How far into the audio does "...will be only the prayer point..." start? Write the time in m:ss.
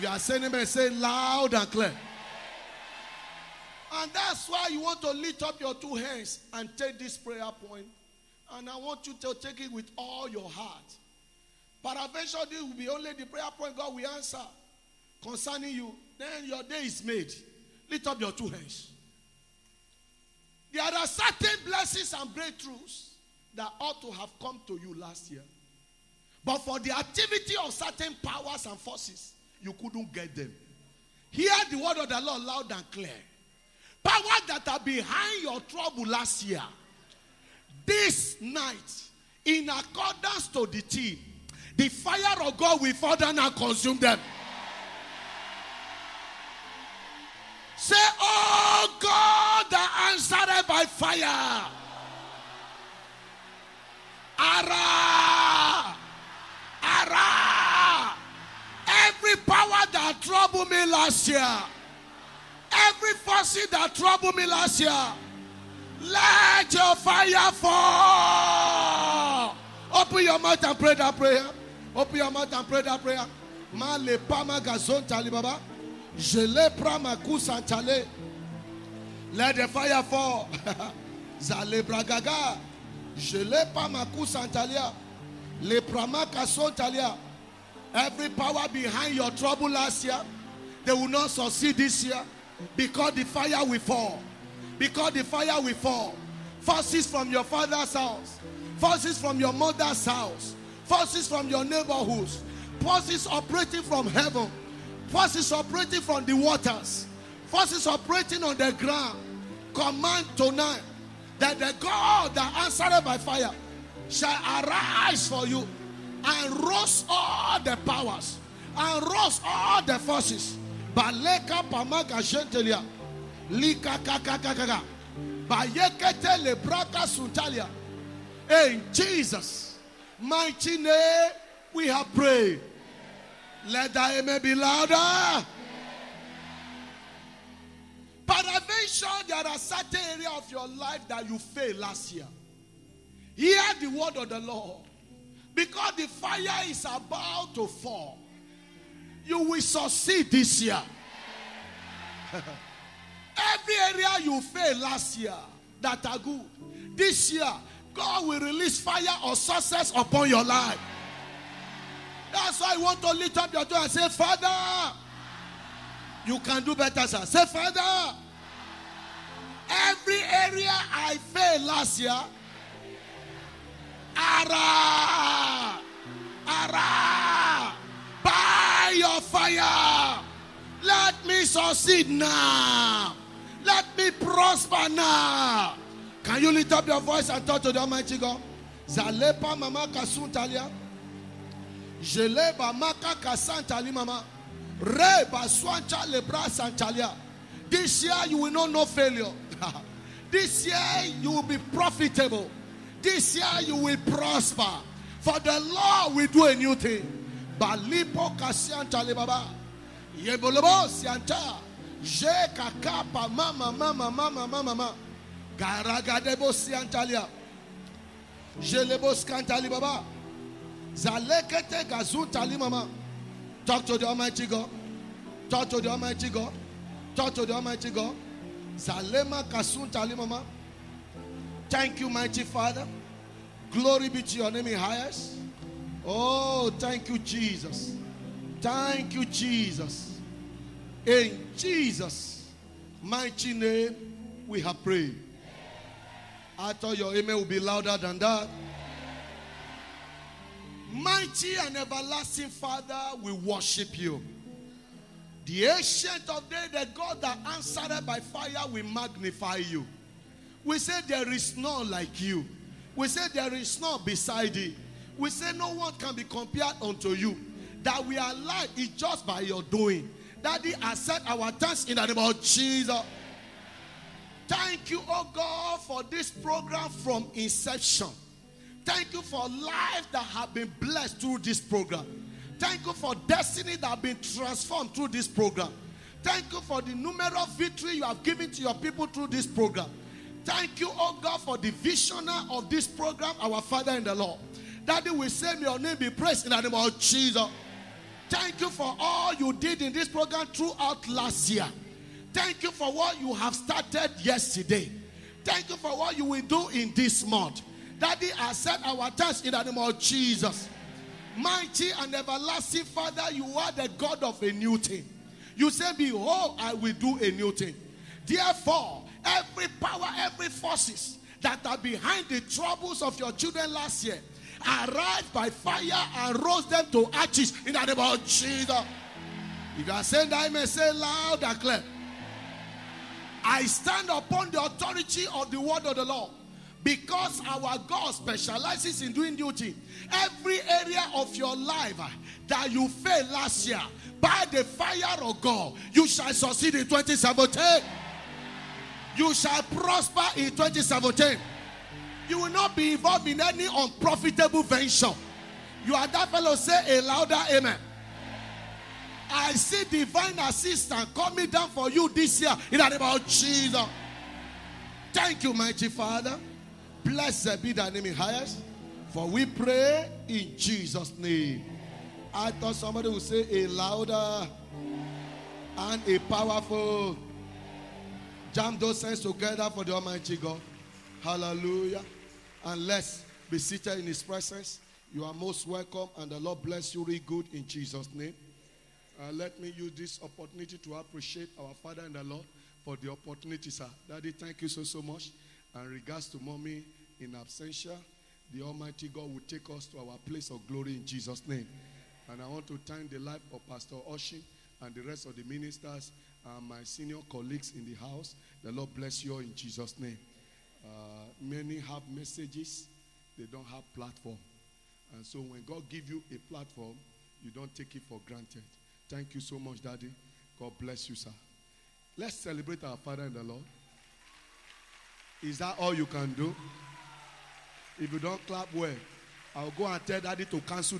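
0:12.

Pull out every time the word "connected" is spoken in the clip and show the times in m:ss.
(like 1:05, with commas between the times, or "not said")
not said.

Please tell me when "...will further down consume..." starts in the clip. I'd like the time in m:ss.
0:42.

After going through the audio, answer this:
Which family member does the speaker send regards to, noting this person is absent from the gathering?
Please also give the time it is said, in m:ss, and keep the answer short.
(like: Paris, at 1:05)
Mommy, at 6:36.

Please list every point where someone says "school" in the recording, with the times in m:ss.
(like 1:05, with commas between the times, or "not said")
not said.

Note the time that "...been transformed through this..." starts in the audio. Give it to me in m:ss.
4:44.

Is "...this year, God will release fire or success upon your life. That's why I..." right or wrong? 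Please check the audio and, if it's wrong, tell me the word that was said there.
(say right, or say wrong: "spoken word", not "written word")
right.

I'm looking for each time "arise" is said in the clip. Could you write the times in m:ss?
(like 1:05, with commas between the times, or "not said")
1:54, 5:24.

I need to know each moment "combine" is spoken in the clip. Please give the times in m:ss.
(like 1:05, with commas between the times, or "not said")
not said.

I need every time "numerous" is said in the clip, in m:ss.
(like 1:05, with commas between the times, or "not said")
4:46.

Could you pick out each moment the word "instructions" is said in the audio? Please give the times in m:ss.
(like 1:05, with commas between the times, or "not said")
not said.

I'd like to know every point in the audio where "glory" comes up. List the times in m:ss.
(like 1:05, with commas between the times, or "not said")
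3:53, 6:40.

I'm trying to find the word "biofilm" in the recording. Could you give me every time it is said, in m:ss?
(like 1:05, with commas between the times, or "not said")
not said.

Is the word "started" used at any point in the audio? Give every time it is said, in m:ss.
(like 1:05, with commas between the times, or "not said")
5:03.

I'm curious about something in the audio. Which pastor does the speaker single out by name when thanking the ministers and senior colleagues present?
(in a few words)
Pastor Oshin.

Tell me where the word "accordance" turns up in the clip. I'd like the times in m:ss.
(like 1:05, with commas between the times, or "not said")
0:39.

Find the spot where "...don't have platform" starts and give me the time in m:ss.
6:53.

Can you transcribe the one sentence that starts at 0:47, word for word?
Say, Oh God, that answered by fire.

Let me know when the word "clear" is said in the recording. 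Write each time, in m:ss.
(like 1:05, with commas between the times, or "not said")
0:01, 0:32, 5:31.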